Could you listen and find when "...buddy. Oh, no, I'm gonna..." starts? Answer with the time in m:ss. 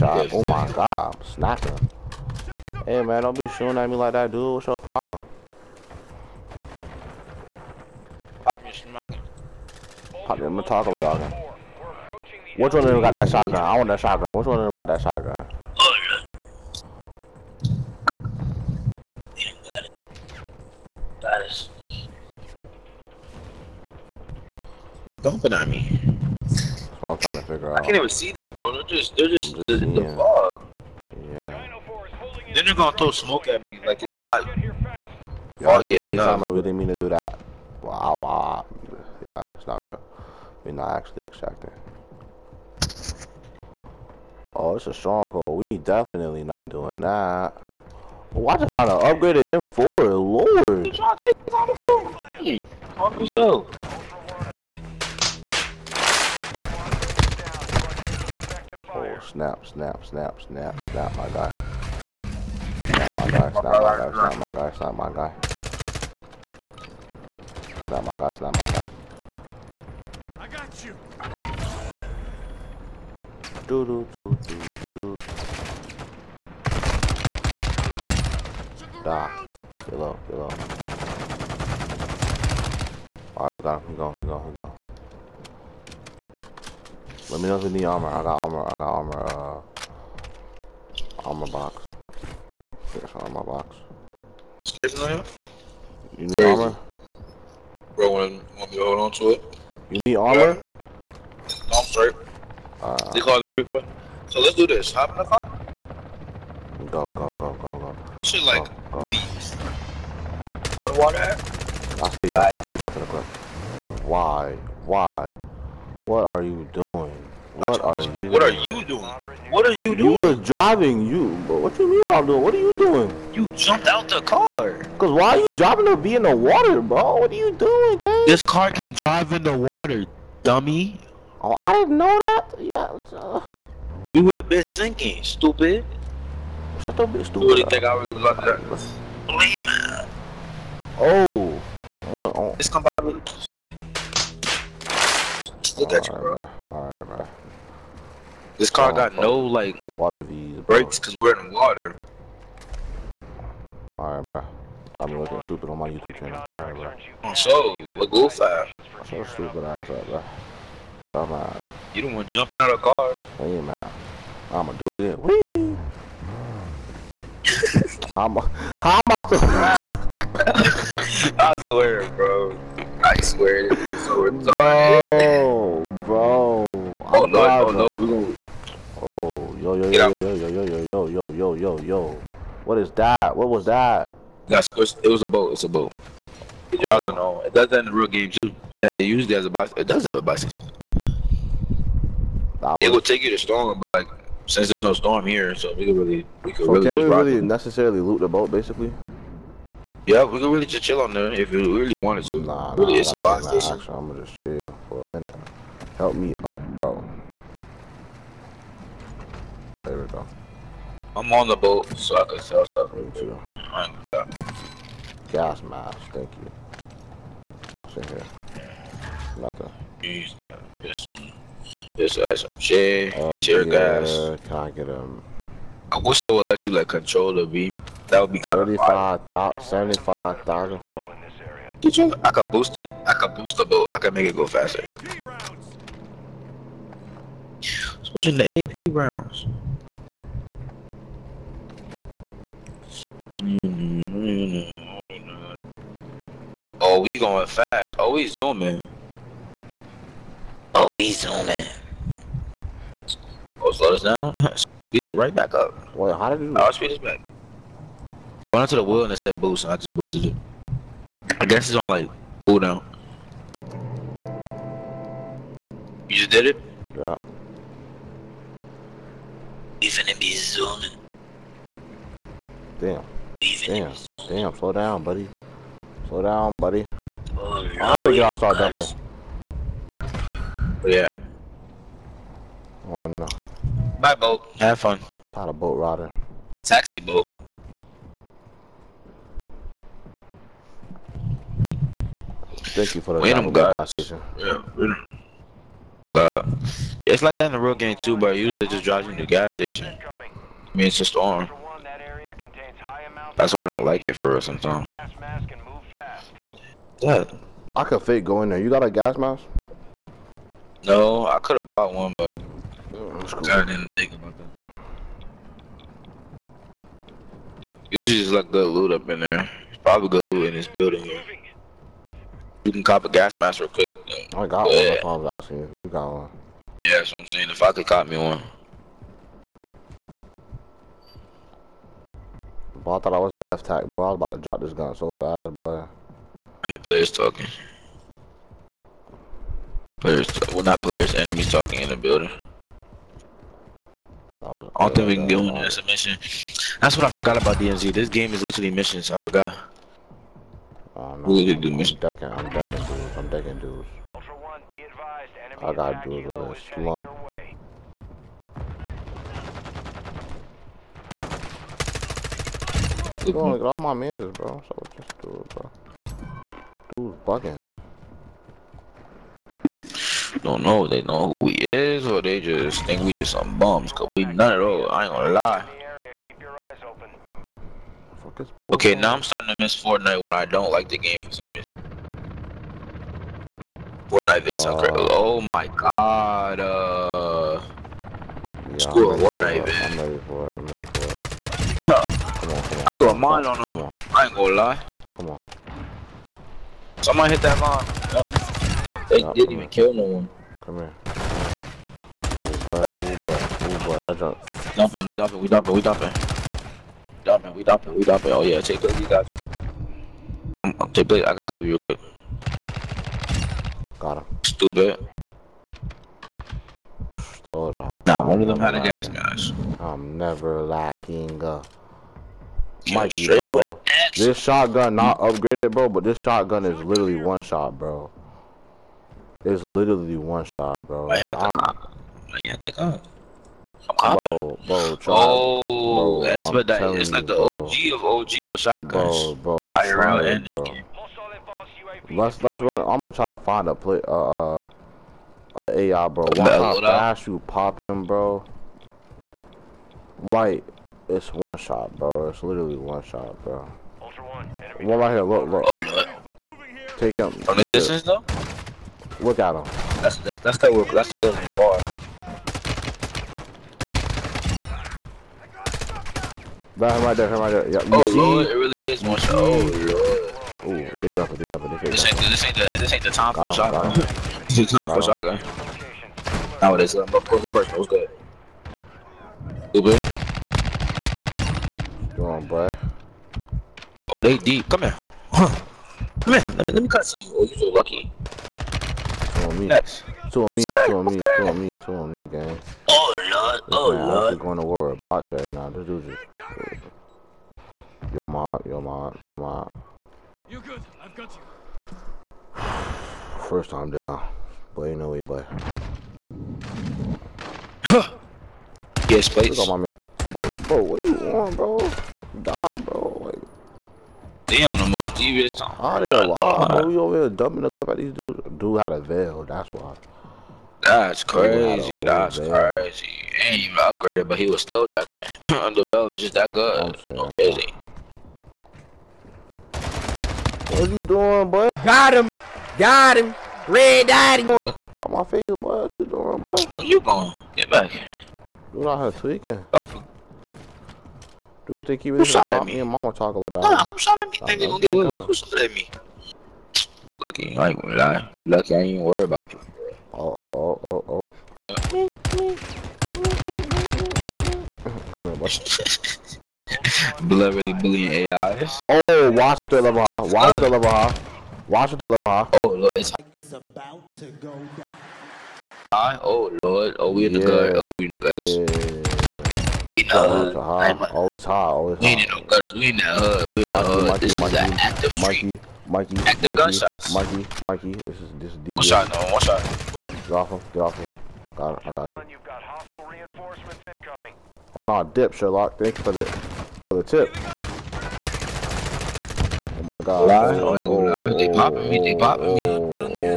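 4:36.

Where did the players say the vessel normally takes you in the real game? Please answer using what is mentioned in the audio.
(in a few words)
Gas station.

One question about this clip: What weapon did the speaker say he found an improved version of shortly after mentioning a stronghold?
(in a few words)
M4.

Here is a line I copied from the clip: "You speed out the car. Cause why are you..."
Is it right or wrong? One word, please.
wrong.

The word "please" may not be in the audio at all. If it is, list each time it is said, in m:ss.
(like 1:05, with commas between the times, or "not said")
1:49, 8:29.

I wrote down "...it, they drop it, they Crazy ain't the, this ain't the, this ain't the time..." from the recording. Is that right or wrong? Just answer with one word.
wrong.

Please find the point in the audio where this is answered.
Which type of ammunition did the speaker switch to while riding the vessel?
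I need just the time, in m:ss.
3:58.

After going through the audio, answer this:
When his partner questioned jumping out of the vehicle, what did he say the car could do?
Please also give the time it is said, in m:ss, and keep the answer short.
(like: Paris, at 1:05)
Drive in the water, at 2:08.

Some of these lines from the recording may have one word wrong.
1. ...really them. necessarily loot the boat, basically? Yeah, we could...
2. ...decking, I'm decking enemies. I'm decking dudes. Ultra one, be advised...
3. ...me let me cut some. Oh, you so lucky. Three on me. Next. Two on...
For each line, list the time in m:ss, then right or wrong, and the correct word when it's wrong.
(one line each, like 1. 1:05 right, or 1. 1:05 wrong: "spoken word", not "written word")
1. 3:17 right
2. 5:52 wrong: "dudes", not "enemies"
3. 8:06 wrong: "Two", not "Three".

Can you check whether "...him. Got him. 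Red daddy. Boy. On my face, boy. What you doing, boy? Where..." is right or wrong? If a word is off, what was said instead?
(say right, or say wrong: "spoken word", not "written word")
right.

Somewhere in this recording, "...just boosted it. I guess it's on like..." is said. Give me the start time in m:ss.
4:19.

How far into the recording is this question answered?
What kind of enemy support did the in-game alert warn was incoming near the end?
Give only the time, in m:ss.
9:42.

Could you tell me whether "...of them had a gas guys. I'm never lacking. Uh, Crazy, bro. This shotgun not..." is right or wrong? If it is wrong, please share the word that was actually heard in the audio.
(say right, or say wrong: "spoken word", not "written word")
wrong: "Mikey", not "Crazy".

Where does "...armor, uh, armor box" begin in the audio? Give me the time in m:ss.
1:28.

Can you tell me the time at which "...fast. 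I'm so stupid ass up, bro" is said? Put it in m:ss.
2:38.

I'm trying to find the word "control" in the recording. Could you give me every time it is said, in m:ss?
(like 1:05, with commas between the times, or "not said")
3:46.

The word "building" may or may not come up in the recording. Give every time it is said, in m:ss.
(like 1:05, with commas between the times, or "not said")
5:20, 5:41.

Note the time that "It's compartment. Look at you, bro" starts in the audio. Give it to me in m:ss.
2:22.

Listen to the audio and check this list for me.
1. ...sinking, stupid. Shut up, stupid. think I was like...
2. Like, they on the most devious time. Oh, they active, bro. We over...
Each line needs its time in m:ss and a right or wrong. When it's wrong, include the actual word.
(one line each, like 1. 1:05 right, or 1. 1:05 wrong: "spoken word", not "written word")
1. 2:14 right
2. 8:33 wrong: "alive", not "active".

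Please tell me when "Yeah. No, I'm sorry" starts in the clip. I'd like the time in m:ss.
1:40.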